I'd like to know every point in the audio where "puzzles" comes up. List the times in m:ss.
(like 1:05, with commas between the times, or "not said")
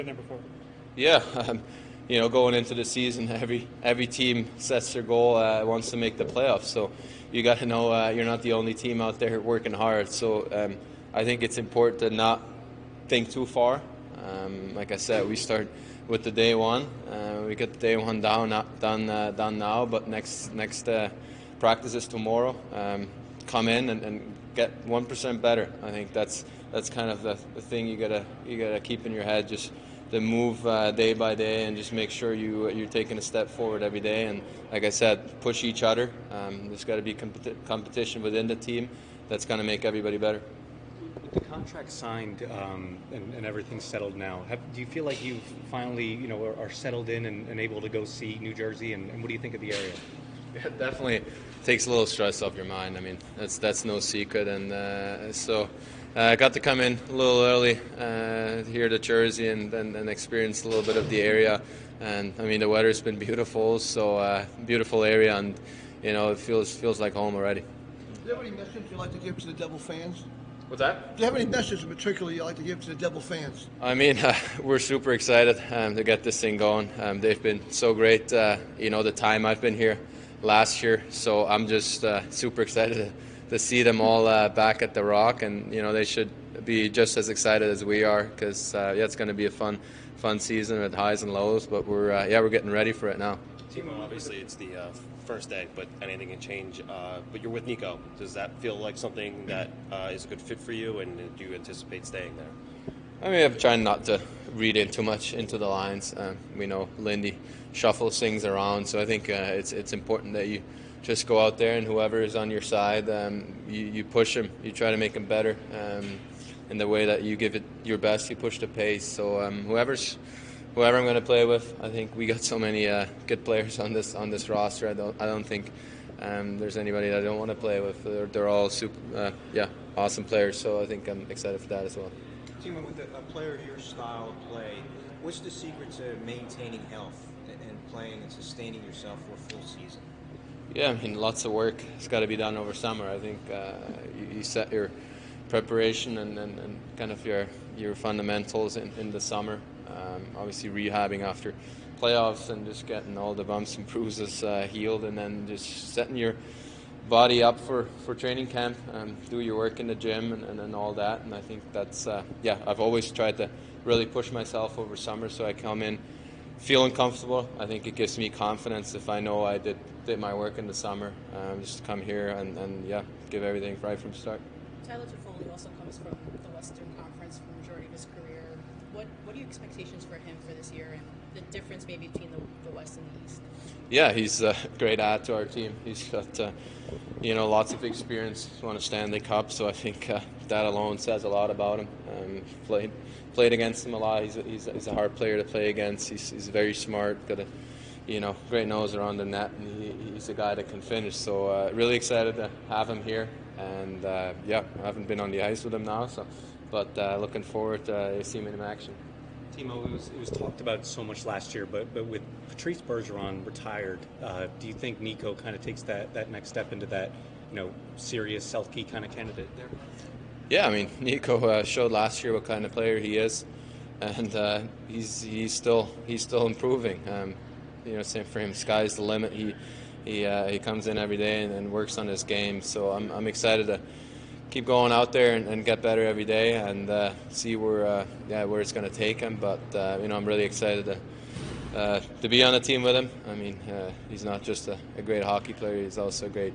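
not said.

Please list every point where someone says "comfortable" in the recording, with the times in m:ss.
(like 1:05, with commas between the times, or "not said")
2:46.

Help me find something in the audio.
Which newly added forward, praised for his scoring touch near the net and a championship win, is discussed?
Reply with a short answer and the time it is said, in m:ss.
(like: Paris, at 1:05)
Tyler Toffoli, at 2:54.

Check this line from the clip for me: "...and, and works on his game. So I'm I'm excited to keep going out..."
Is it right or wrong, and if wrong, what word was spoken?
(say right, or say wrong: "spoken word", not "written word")
right.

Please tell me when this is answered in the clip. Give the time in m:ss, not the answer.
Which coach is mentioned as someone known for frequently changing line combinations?
1:46.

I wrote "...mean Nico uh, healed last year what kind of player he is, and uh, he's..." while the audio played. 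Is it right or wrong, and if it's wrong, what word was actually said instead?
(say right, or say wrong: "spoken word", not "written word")
wrong: "showed", not "healed".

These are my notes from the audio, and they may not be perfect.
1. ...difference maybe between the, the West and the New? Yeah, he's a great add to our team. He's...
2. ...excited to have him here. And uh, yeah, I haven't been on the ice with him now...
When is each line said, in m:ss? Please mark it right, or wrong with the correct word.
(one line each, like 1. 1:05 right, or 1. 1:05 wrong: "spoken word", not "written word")
1. 3:01 wrong: "East", not "New"
2. 3:21 right.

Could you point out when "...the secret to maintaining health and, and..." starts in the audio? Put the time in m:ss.
2:15.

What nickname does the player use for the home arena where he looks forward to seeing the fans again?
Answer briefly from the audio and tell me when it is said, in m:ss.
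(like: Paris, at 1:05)
the Rock, at 1:24.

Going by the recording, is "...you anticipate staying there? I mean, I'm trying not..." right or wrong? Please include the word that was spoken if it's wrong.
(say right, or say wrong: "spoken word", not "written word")
right.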